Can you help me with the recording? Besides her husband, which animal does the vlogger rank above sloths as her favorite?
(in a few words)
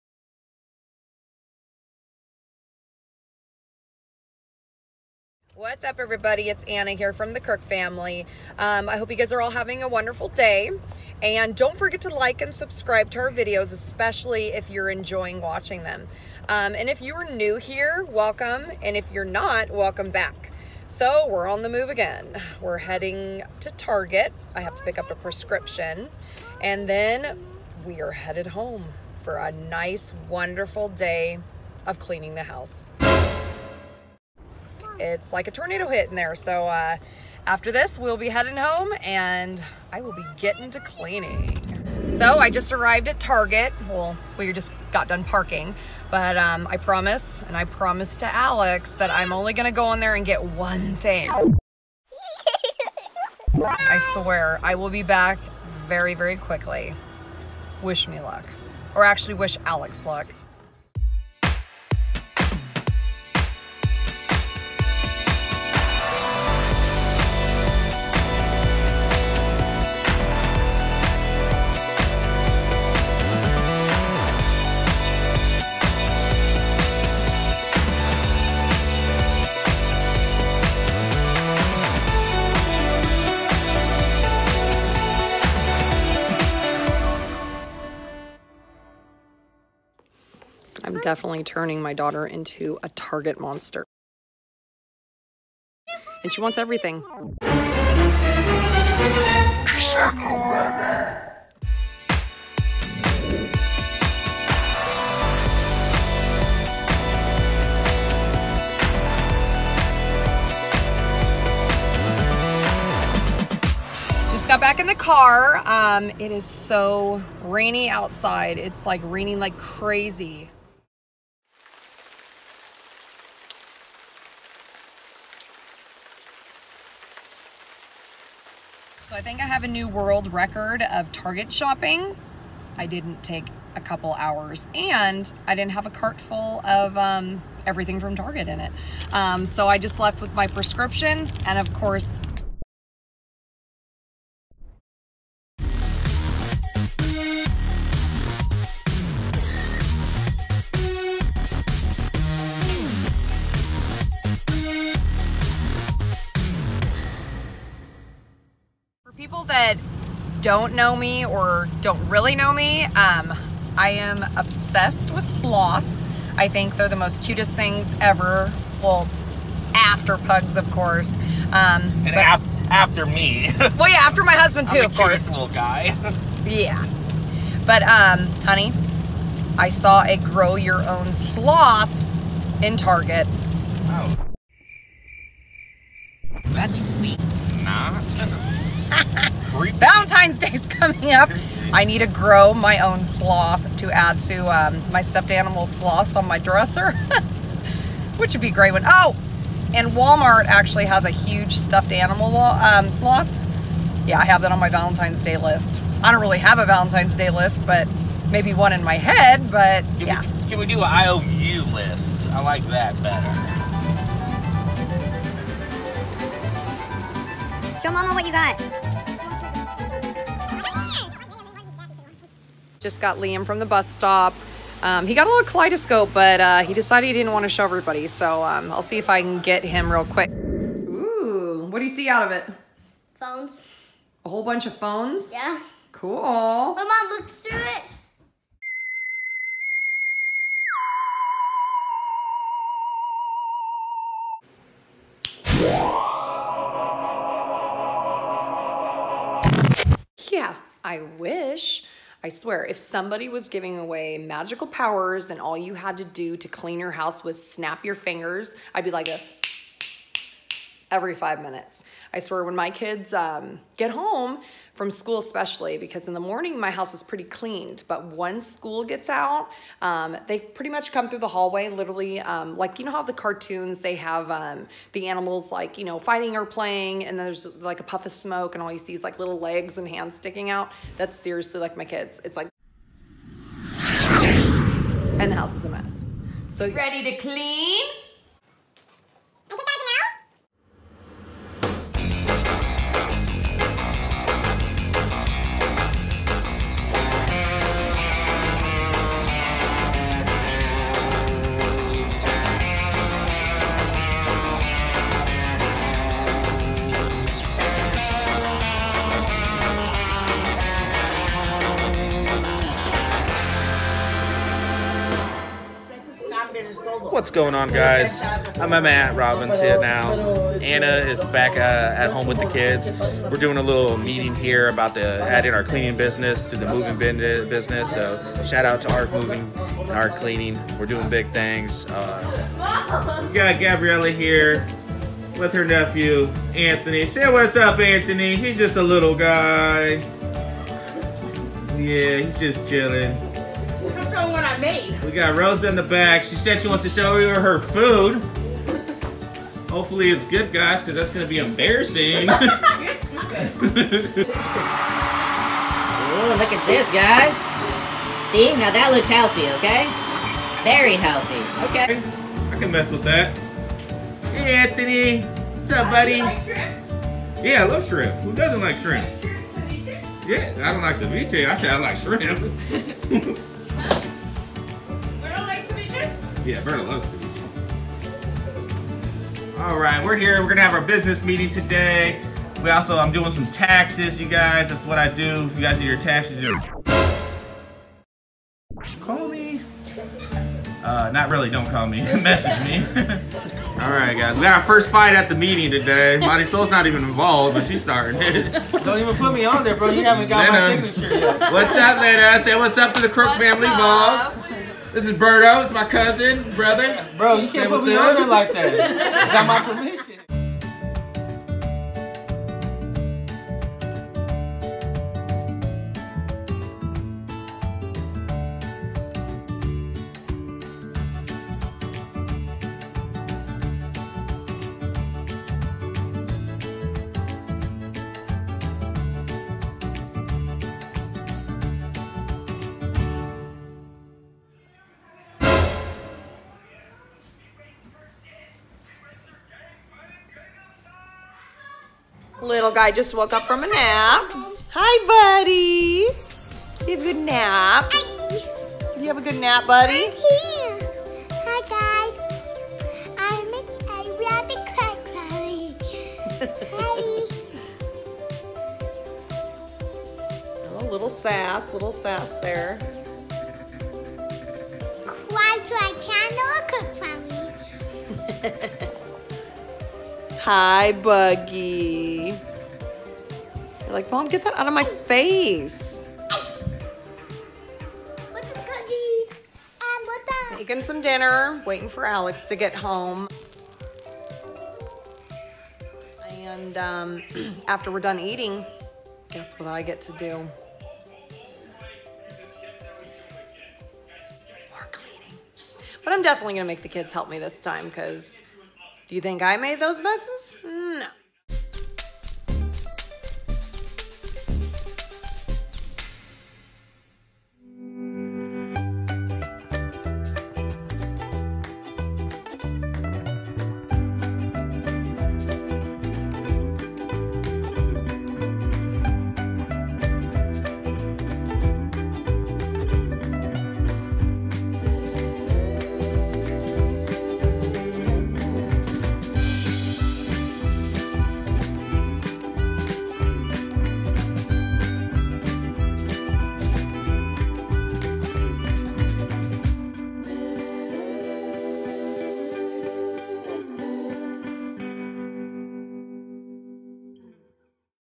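Pugs.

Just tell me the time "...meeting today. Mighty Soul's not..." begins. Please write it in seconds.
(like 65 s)
395 s.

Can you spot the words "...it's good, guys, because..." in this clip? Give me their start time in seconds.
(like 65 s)
350 s.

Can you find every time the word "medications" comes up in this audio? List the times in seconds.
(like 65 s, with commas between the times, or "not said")
not said.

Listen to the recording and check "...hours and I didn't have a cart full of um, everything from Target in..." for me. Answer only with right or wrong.
right.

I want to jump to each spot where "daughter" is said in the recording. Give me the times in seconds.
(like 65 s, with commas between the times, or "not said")
91 s.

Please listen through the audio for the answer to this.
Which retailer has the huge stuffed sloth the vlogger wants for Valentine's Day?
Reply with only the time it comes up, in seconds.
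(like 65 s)
199 s.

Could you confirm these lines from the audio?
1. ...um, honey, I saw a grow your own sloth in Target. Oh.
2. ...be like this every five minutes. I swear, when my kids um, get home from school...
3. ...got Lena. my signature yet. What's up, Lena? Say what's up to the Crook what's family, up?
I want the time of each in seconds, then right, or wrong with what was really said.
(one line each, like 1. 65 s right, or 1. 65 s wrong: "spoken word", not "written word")
1. 177 s right
2. 258 s right
3. 400 s right.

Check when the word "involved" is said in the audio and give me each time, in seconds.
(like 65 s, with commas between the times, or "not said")
397 s.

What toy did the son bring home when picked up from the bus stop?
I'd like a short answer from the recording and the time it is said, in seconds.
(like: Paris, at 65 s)
Kaleidoscope, at 225 s.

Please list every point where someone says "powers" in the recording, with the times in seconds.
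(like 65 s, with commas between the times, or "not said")
254 s.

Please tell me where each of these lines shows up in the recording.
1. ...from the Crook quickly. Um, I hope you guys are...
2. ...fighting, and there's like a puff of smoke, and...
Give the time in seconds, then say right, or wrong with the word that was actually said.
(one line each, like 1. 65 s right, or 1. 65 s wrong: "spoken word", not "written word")
1. 7 s wrong: "family", not "quickly"
2. 276 s wrong: "playing", not "fighting".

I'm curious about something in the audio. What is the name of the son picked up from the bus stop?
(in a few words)
Liam.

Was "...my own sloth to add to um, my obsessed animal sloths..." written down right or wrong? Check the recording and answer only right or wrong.
wrong.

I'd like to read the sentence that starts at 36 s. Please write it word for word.
So uh, after this, we'll be heading home and I will be getting to cleaning.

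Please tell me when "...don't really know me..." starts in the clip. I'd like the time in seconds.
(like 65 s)
161 s.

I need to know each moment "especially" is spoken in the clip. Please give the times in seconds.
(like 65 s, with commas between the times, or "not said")
13 s, 265 s.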